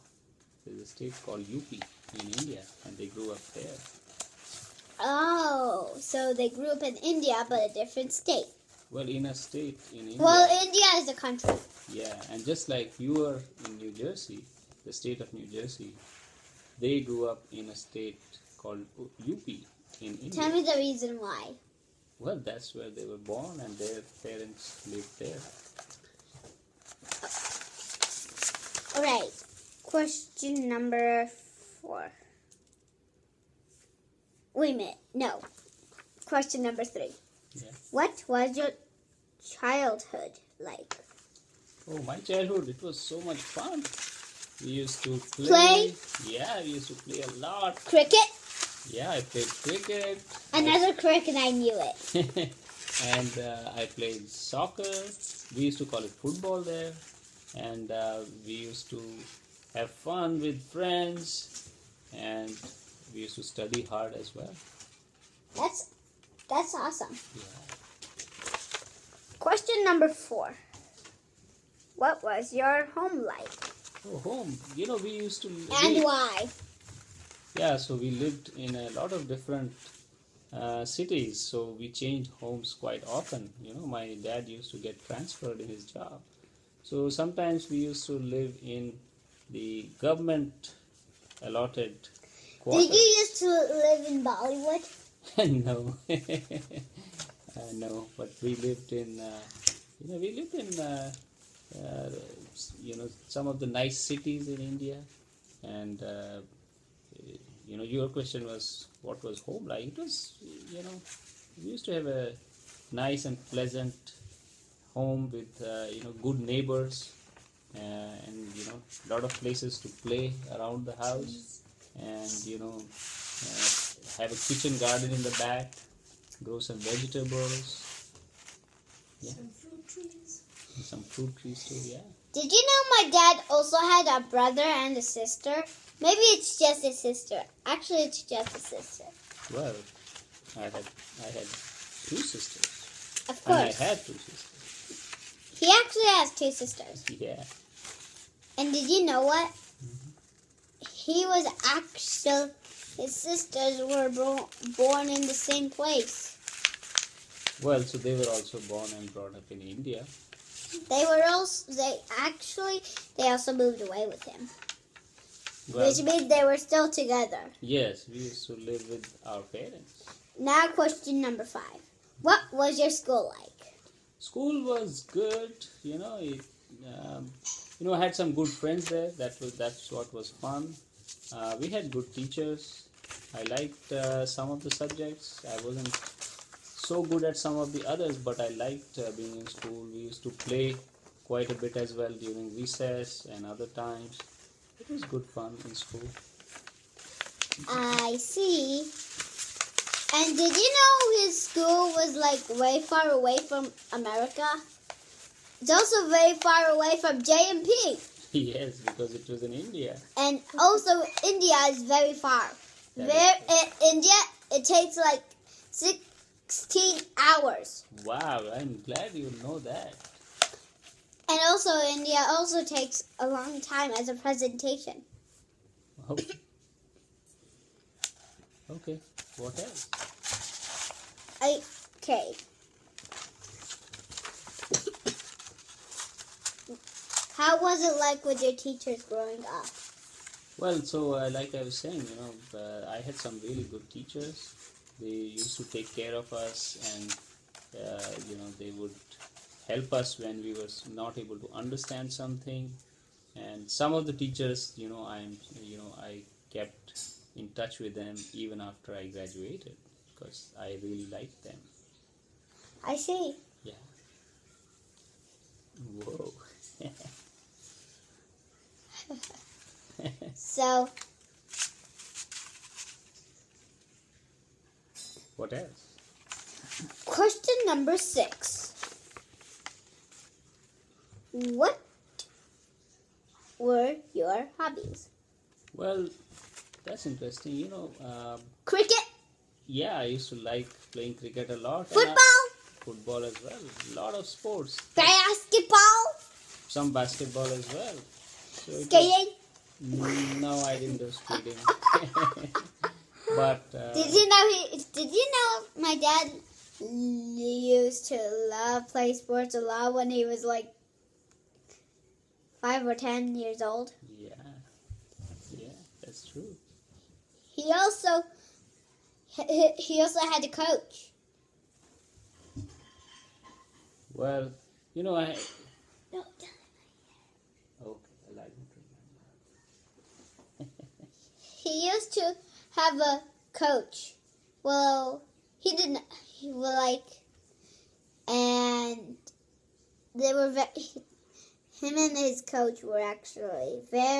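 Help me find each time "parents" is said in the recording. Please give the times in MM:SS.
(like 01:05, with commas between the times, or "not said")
00:24, 02:49.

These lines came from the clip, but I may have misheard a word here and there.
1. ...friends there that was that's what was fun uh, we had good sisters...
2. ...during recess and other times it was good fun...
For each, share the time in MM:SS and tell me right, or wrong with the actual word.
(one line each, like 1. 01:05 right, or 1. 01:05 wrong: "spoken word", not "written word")
1. 02:58 wrong: "teachers", not "sisters"
2. 03:12 right.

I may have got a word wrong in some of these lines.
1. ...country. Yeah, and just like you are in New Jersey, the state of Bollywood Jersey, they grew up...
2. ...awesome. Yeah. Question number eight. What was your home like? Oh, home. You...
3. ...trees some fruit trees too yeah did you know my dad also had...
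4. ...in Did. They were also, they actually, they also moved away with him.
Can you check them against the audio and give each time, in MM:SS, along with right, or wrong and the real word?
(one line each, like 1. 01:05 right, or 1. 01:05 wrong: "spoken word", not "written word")
1. 00:11 wrong: "New", not "Bollywood"
2. 01:06 wrong: "four", not "eight"
3. 02:09 right
4. 02:39 wrong: "India", not "Did".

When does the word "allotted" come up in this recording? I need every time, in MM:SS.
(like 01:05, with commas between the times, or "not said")
01:31.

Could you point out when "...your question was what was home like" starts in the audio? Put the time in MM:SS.
01:47.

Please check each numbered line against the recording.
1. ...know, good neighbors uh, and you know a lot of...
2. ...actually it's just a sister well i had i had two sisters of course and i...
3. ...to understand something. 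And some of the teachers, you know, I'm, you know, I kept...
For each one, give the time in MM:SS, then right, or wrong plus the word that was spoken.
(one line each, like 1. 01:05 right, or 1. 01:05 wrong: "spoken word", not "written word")
1. 01:56 right
2. 02:17 right
3. 04:11 right.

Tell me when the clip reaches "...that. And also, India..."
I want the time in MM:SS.
03:39.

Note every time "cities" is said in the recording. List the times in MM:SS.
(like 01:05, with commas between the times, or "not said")
01:20, 01:43.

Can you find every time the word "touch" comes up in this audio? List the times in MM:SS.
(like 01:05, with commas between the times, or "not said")
04:17.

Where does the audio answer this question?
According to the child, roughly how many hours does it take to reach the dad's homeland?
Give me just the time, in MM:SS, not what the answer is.
03:35.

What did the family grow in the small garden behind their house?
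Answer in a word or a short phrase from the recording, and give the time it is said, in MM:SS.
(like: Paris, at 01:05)
vegetables, at 02:06.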